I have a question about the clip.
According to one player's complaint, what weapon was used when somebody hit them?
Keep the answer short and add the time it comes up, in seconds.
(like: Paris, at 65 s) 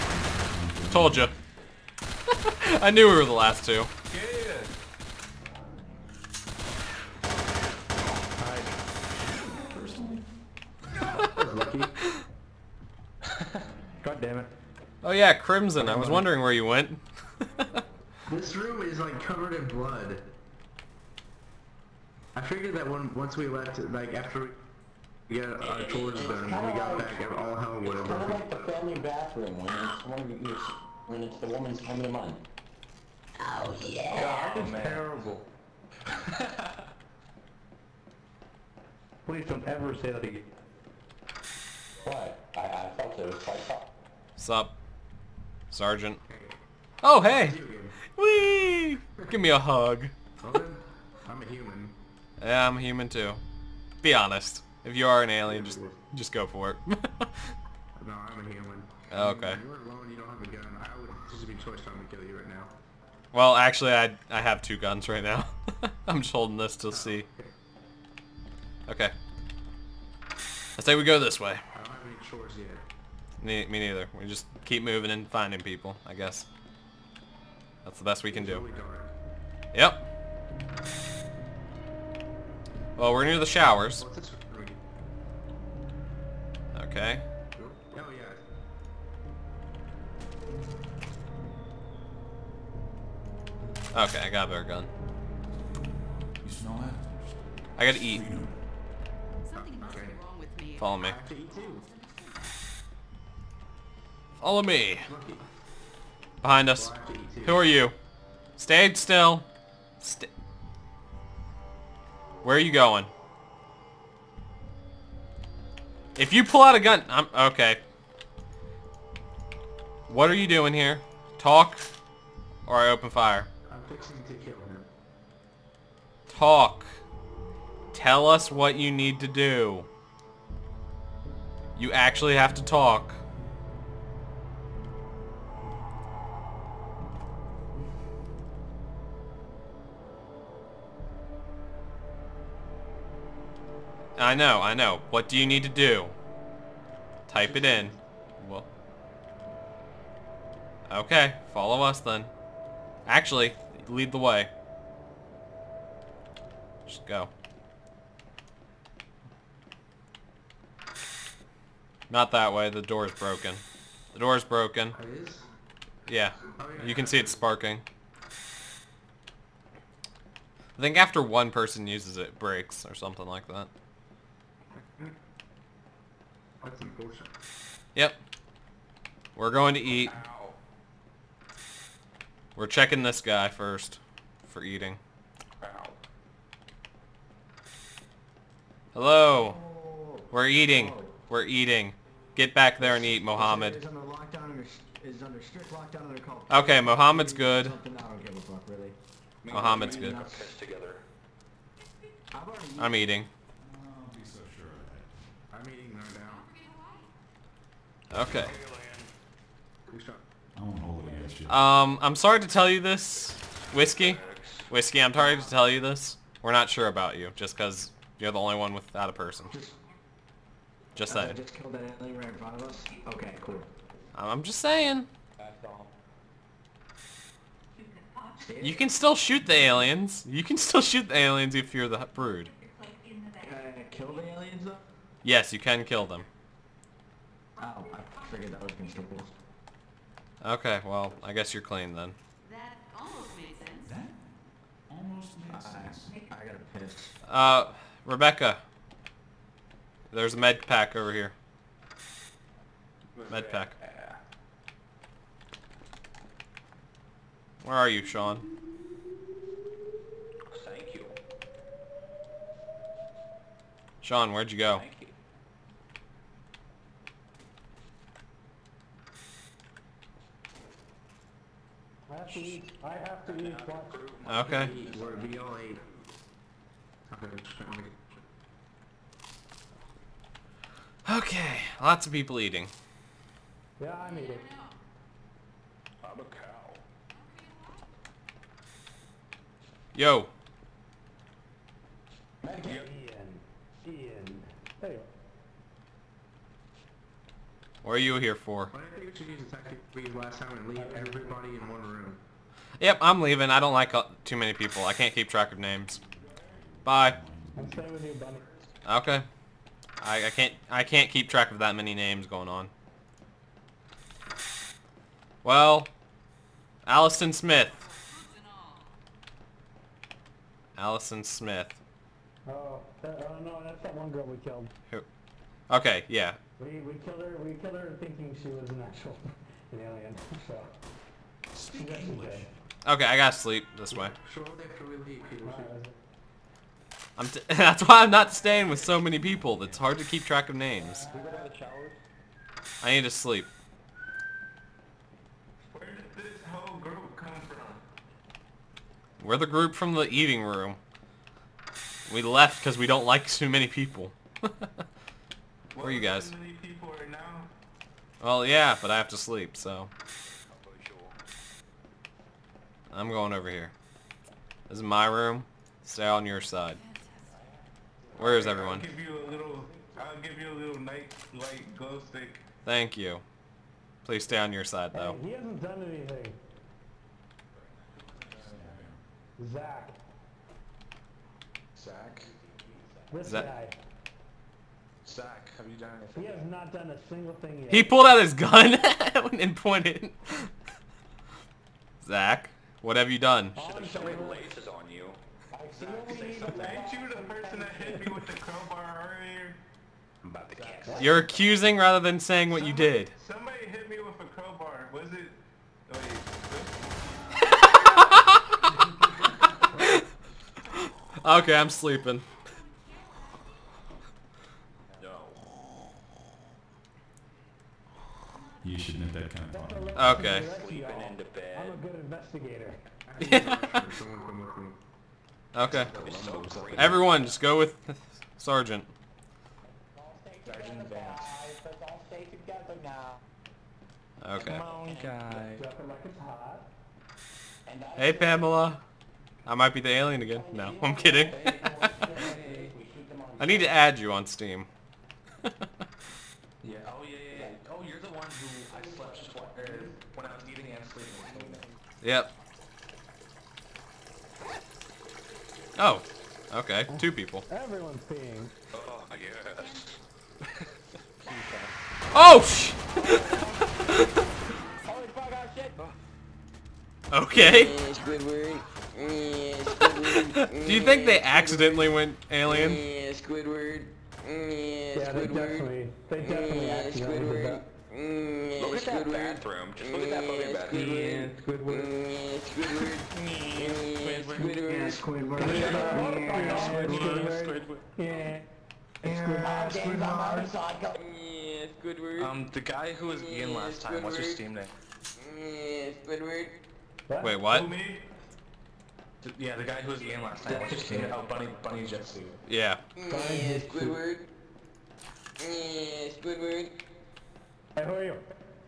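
Crowbar, at 404 s.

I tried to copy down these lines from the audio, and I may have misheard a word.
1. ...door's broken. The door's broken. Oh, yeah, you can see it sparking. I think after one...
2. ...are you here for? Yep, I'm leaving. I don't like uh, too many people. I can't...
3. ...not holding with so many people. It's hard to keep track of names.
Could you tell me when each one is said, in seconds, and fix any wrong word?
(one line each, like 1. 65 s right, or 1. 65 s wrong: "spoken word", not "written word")
1. 162 s right
2. 297 s right
3. 338 s wrong: "staying", not "holding".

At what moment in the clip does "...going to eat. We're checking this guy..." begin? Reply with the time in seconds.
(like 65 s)
179 s.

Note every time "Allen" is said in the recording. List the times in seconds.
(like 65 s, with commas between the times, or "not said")
not said.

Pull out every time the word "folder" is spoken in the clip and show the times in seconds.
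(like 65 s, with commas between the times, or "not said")
not said.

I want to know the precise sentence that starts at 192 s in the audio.
Get back there and eat, Mohammed.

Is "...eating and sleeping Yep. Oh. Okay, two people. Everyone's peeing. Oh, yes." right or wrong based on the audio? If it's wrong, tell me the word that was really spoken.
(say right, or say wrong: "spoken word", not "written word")
right.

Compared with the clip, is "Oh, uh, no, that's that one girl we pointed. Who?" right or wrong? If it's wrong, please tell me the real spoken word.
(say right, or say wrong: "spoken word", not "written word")
wrong: "killed", not "pointed".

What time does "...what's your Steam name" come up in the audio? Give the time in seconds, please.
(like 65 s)
494 s.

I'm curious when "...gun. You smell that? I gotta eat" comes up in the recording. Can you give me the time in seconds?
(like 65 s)
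94 s.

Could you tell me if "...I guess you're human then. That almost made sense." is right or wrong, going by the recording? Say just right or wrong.
wrong.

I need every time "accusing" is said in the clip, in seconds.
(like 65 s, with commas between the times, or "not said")
401 s.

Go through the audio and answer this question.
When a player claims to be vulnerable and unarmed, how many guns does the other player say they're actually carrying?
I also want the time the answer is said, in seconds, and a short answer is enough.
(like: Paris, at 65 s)
2, at 64 s.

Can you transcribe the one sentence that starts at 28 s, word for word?
It's kind of like the family bathroom when it's, when it's, when it's the woman's coming to mind.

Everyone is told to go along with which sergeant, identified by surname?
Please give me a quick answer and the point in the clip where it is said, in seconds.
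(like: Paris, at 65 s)
Vance, at 430 s.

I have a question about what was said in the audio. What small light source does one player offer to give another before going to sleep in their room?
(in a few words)
Glow stick.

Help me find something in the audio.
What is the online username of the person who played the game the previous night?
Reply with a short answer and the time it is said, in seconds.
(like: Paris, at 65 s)
Bunny Jitsu, at 501 s.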